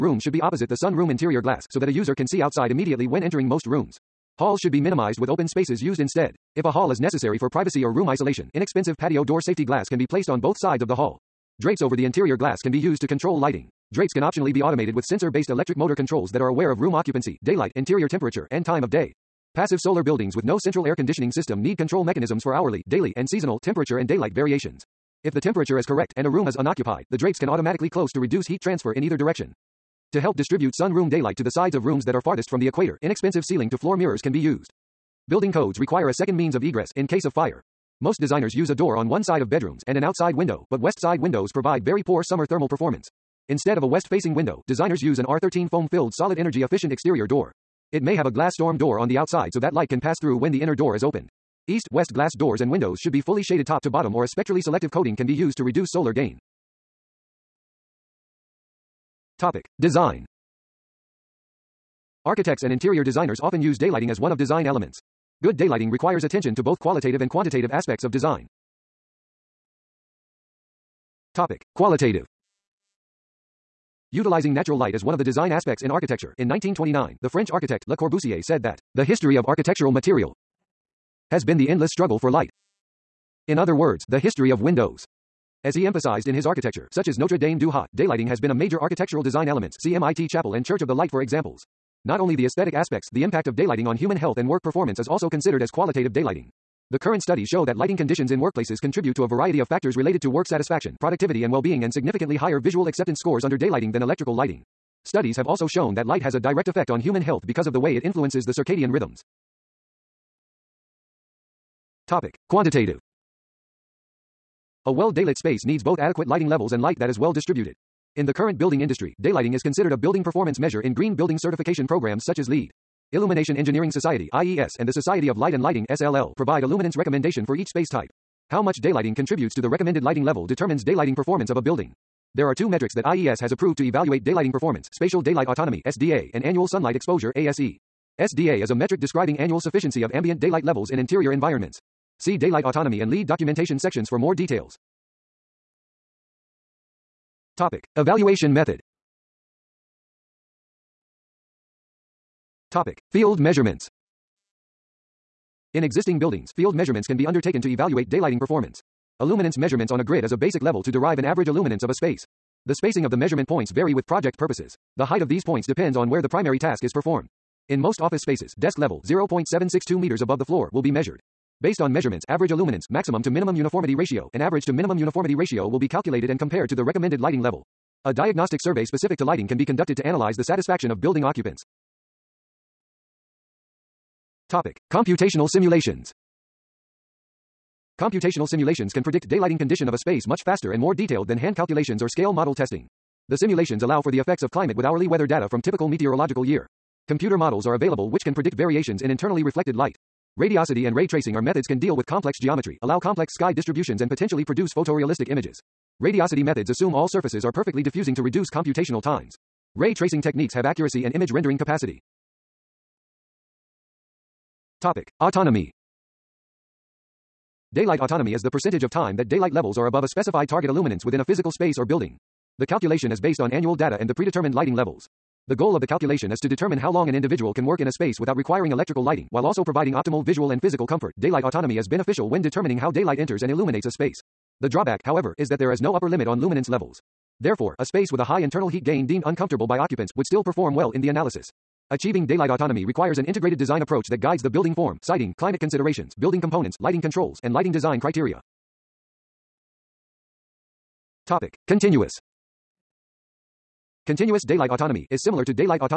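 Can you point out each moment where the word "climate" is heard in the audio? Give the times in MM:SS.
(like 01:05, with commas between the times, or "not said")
03:14, 04:05.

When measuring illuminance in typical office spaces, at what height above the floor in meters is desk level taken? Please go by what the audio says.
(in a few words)
0.762 meters.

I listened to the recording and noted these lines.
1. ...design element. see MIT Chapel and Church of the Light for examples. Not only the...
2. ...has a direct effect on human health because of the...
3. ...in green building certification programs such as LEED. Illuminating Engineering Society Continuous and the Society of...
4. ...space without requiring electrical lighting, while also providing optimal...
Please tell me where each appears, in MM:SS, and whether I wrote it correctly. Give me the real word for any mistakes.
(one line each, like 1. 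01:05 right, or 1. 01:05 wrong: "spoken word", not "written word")
1. 01:29 right
2. 01:46 right
3. 02:00 wrong: "IES", not "Continuous"
4. 03:47 right.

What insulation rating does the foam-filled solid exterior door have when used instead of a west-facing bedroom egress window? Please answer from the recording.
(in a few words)
R13.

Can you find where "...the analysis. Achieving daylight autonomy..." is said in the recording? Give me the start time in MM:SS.
04:01.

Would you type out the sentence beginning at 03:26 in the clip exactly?
Radiosity methods assume all surfaces are perfectly diffusing to reduce computational times.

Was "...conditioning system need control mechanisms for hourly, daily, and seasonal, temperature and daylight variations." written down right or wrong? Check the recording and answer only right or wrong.
right.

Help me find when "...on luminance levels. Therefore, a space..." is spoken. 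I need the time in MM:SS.
03:56.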